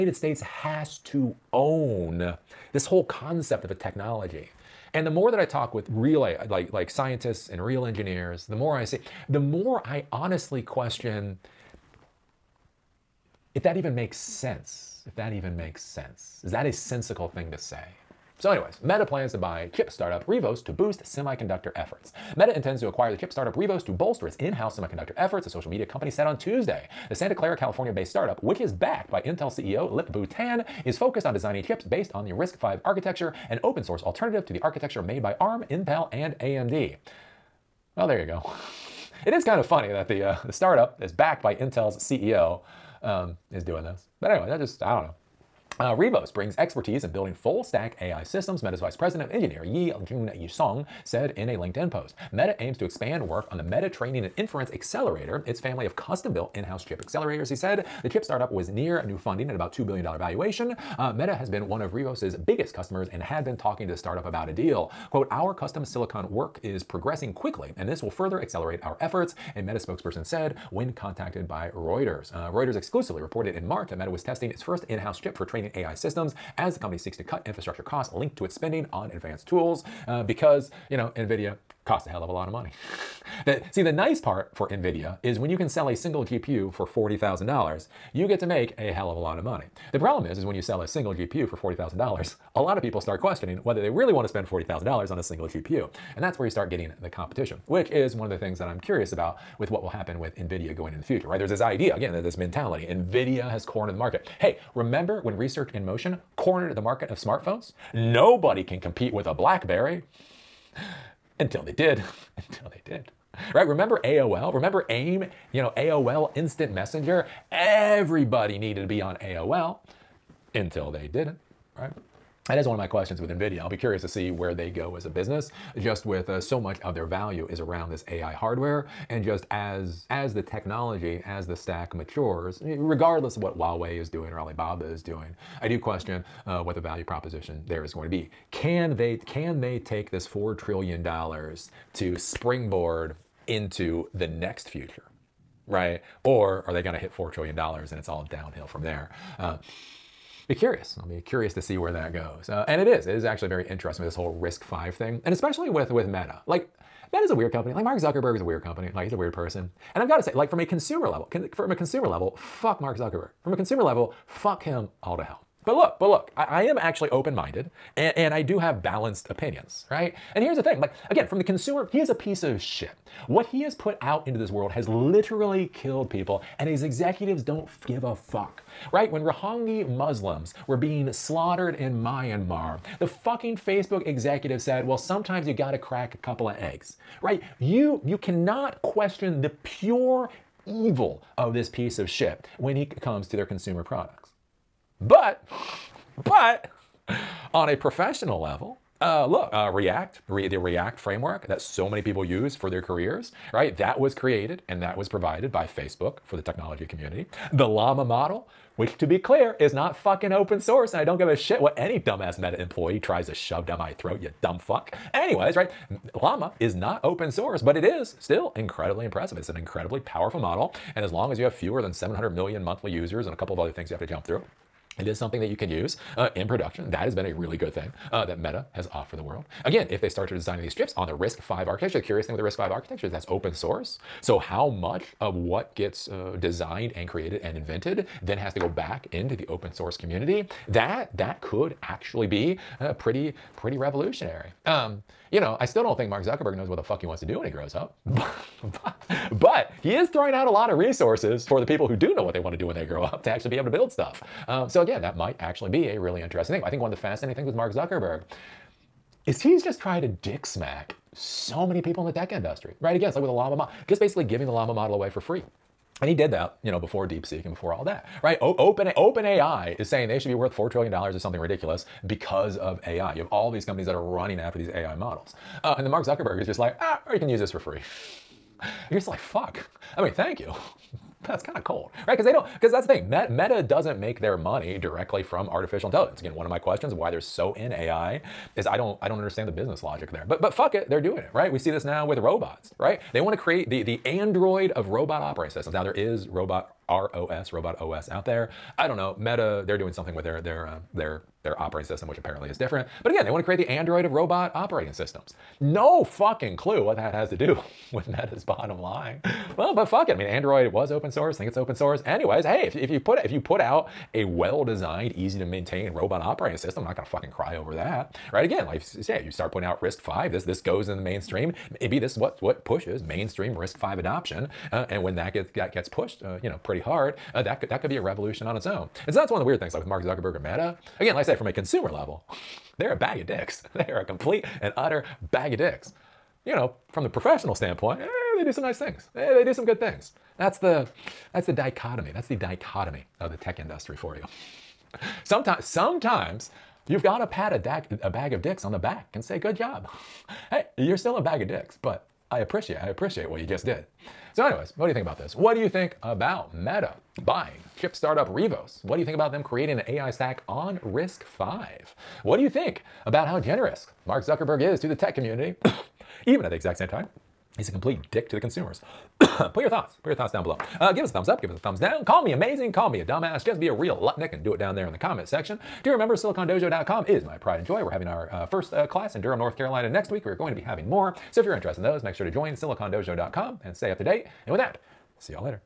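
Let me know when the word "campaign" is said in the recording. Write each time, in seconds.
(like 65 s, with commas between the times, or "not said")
not said.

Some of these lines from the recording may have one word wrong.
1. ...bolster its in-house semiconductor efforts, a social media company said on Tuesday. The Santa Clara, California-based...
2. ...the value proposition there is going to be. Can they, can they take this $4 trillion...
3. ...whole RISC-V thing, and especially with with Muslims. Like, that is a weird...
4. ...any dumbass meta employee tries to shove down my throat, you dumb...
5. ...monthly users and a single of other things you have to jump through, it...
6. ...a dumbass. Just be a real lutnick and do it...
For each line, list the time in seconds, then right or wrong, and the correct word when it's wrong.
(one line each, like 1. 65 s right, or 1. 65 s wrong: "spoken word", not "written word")
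1. 23 s right
2. 136 s right
3. 154 s wrong: "Meta", not "Muslims"
4. 211 s right
5. 222 s wrong: "couple", not "single"
6. 373 s right.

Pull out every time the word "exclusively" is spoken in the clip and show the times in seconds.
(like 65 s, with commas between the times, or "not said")
72 s.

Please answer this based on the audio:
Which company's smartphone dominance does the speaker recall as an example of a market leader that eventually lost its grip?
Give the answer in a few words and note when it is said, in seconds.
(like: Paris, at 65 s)
Research in Motion, at 105 s.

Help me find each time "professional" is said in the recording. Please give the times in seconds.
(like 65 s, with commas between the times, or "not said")
197 s, 337 s.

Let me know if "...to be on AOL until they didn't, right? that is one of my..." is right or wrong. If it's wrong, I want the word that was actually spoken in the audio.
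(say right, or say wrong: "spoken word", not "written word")
right.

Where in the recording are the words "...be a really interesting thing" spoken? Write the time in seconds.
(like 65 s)
255 s.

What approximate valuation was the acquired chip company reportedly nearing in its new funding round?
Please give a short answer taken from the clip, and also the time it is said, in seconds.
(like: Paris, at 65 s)
$2 billion, at 59 s.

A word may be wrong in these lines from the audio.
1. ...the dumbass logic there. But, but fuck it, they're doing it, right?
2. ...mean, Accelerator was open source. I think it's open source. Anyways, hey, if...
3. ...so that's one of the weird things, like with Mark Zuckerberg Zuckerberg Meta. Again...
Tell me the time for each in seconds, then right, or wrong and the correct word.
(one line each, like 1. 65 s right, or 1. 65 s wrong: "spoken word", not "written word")
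1. 289 s wrong: "business", not "dumbass"
2. 310 s wrong: "Android", not "Accelerator"
3. 329 s right.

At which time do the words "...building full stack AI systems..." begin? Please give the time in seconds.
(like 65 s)
47 s.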